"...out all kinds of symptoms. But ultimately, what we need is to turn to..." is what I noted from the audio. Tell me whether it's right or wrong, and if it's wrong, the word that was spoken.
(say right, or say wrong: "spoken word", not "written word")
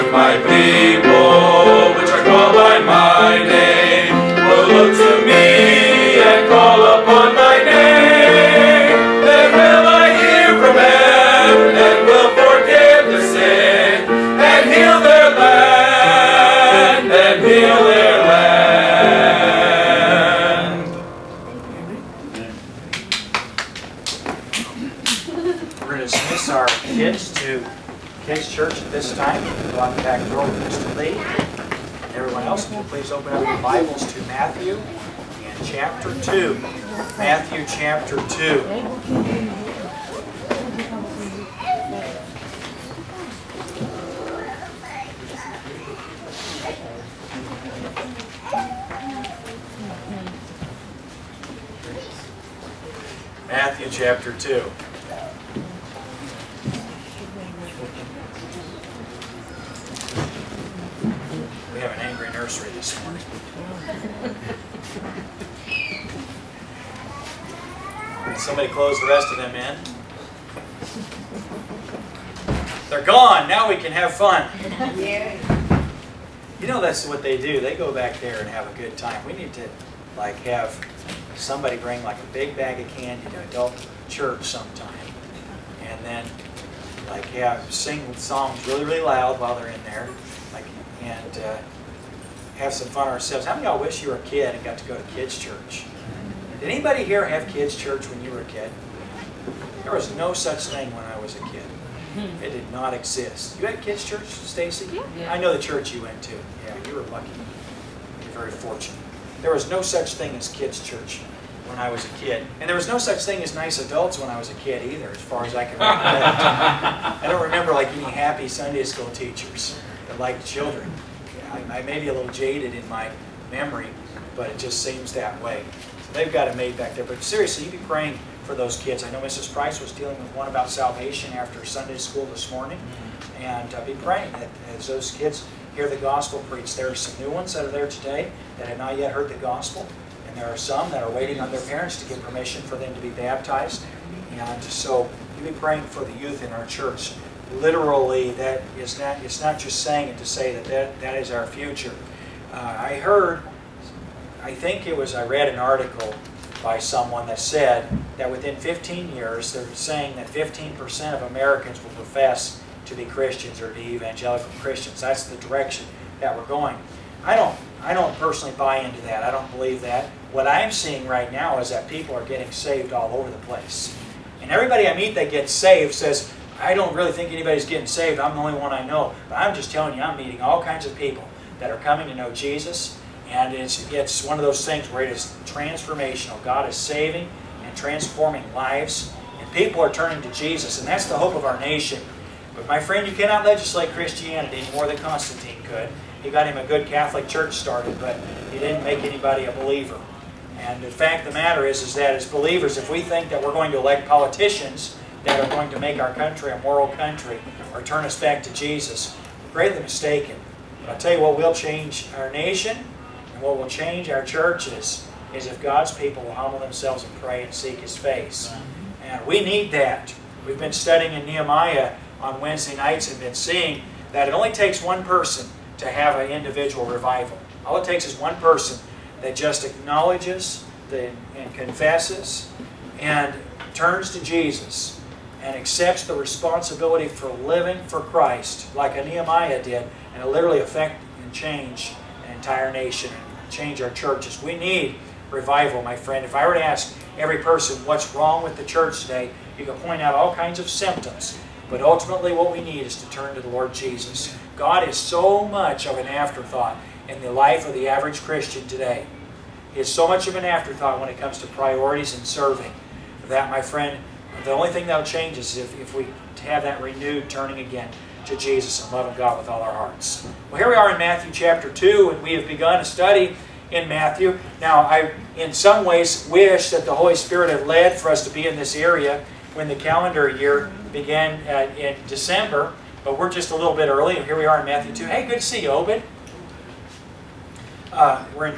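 right.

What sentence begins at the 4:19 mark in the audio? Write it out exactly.
He is so much of an afterthought when it comes to priorities and serving.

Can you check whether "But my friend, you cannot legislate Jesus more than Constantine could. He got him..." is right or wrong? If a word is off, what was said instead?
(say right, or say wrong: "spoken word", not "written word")
wrong: "Christianity", not "Jesus".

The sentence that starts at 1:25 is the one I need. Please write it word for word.
And then like have sing songs really, really loud while they're in there.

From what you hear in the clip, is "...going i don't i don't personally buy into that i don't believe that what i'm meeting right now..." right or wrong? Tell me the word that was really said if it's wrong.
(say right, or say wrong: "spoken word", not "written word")
wrong: "seeing", not "meeting".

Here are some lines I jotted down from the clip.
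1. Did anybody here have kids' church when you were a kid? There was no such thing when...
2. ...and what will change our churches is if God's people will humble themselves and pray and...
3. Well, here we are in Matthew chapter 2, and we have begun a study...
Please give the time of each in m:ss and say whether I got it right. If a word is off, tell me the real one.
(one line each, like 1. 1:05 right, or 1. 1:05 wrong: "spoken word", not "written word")
1. 1:36 right
2. 3:33 right
3. 4:30 right.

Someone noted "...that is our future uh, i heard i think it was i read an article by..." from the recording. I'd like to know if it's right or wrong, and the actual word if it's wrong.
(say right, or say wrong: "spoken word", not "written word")
right.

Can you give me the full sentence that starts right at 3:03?
And it's, it's one of those things where it is transformational.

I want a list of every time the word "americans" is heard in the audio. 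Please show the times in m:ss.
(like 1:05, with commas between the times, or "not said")
2:41.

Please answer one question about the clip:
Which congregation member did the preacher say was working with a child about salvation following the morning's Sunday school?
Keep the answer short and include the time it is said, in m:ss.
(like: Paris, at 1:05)
Mrs. Price, at 2:09.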